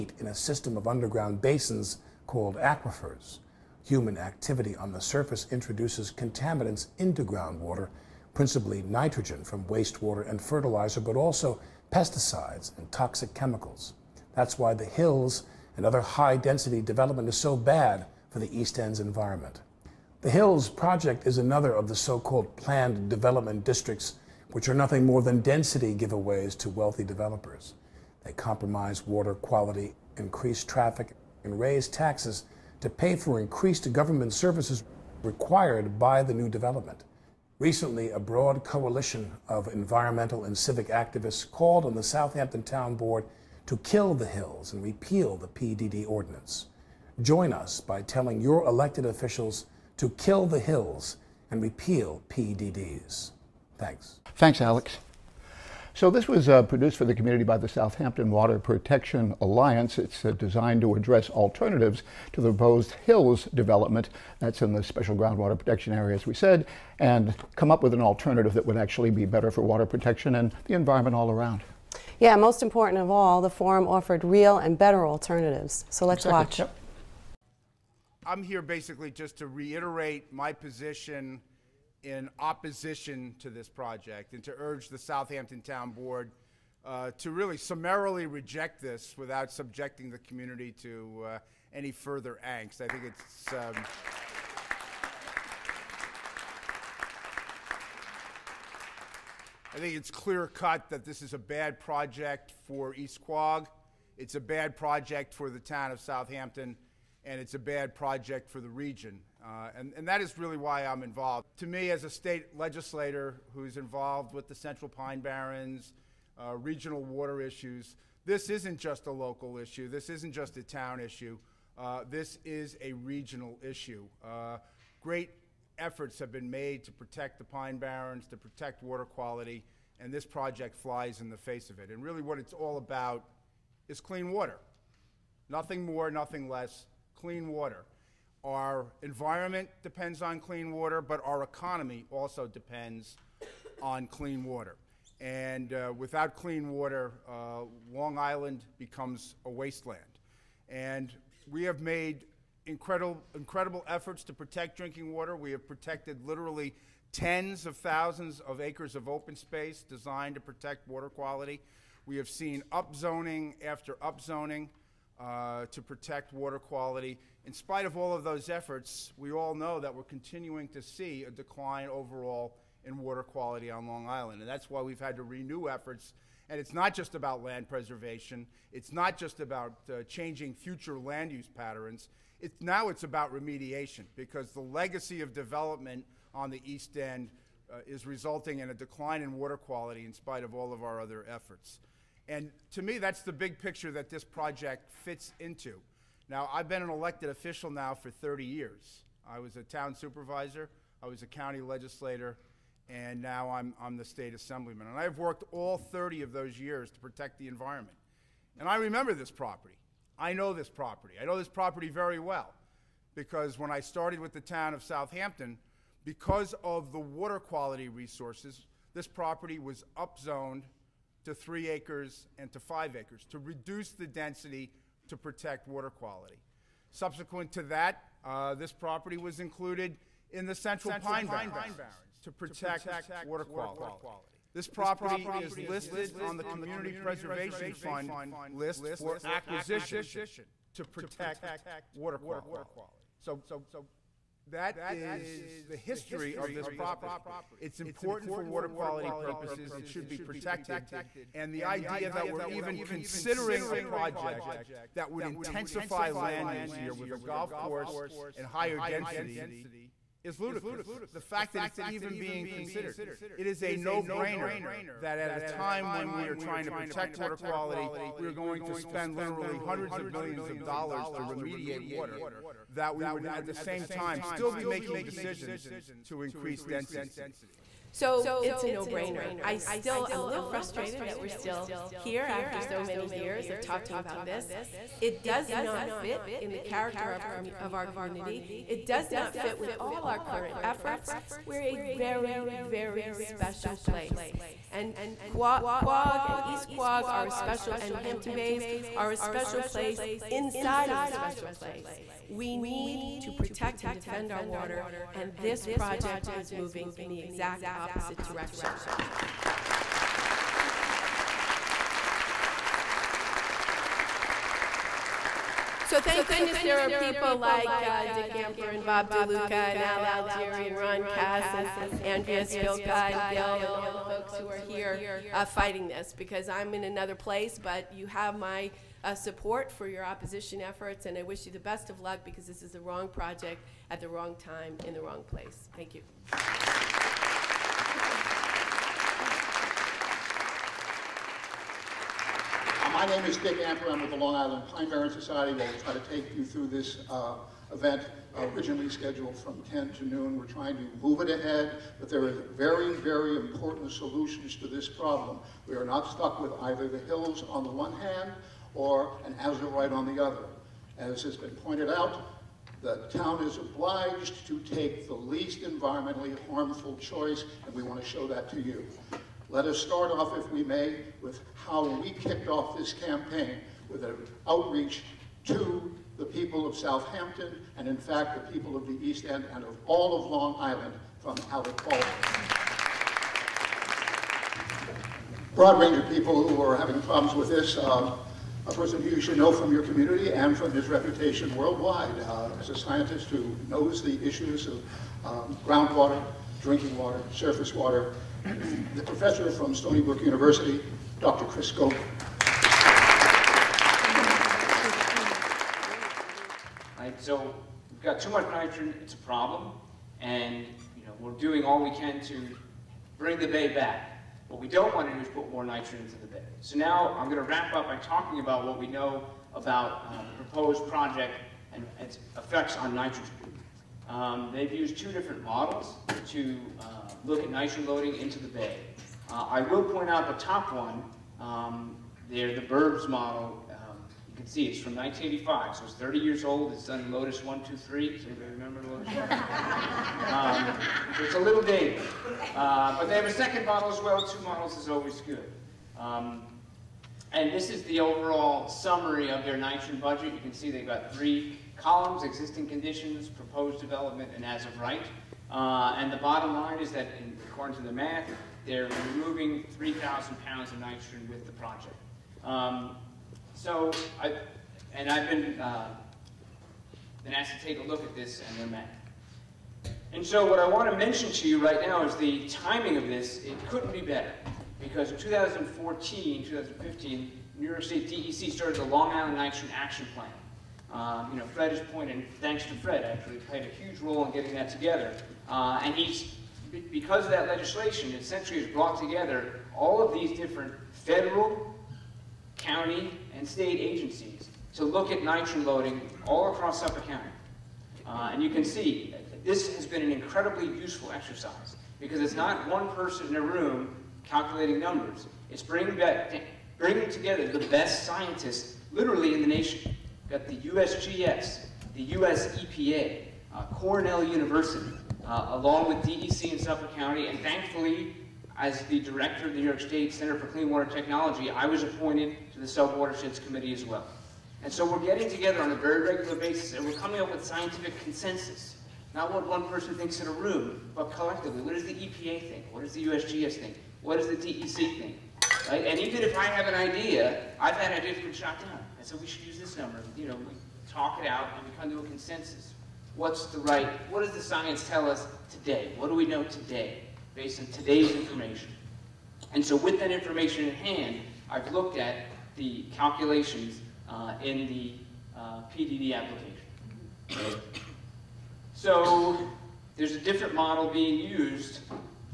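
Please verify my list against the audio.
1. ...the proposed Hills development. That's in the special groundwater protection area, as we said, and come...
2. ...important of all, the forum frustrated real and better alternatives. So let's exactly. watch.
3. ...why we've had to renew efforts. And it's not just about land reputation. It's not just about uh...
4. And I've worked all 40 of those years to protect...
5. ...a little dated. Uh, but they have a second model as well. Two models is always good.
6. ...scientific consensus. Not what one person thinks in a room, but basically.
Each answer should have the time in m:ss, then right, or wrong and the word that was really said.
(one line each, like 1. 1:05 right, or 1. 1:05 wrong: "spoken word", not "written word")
1. 1:02 right
2. 1:12 wrong: "offered", not "frustrated"
3. 2:54 wrong: "preservation", not "reputation"
4. 3:24 wrong: "30", not "40"
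5. 7:21 right
6. 8:47 wrong: "collectively", not "basically".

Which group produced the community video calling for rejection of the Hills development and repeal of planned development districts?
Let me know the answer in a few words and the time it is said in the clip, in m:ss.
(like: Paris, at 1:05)
Southampton Water Protection Alliance, at 0:57.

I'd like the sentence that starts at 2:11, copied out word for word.
And really what it's all about is clean water.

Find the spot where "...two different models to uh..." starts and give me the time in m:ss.
7:04.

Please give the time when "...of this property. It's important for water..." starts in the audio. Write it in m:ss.
4:06.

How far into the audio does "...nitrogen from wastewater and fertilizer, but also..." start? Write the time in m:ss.
0:08.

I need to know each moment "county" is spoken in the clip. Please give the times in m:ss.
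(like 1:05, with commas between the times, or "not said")
3:21, 8:12, 8:17, 8:36.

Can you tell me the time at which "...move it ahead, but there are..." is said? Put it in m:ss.
5:51.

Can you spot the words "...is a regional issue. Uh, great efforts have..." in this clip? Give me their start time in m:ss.
2:02.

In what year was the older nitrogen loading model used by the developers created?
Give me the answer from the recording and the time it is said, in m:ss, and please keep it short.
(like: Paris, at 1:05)
1985, at 7:14.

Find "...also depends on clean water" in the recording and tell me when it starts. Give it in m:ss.
2:22.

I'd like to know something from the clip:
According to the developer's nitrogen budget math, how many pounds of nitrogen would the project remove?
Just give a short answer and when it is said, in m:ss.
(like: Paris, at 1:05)
3,000 pounds, at 7:39.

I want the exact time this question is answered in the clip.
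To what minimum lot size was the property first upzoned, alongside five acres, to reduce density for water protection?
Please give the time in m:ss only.
3:41.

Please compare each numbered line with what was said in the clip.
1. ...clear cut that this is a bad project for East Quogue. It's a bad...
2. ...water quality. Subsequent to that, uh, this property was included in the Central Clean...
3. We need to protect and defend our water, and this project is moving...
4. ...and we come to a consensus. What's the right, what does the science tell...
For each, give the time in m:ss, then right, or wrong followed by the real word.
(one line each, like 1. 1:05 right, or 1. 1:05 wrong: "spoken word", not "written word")
1. 1:40 right
2. 3:45 wrong: "Pine", not "Clean"
3. 5:02 right
4. 9:01 right.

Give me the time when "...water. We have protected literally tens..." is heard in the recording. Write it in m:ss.
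2:35.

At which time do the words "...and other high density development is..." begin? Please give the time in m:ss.
0:15.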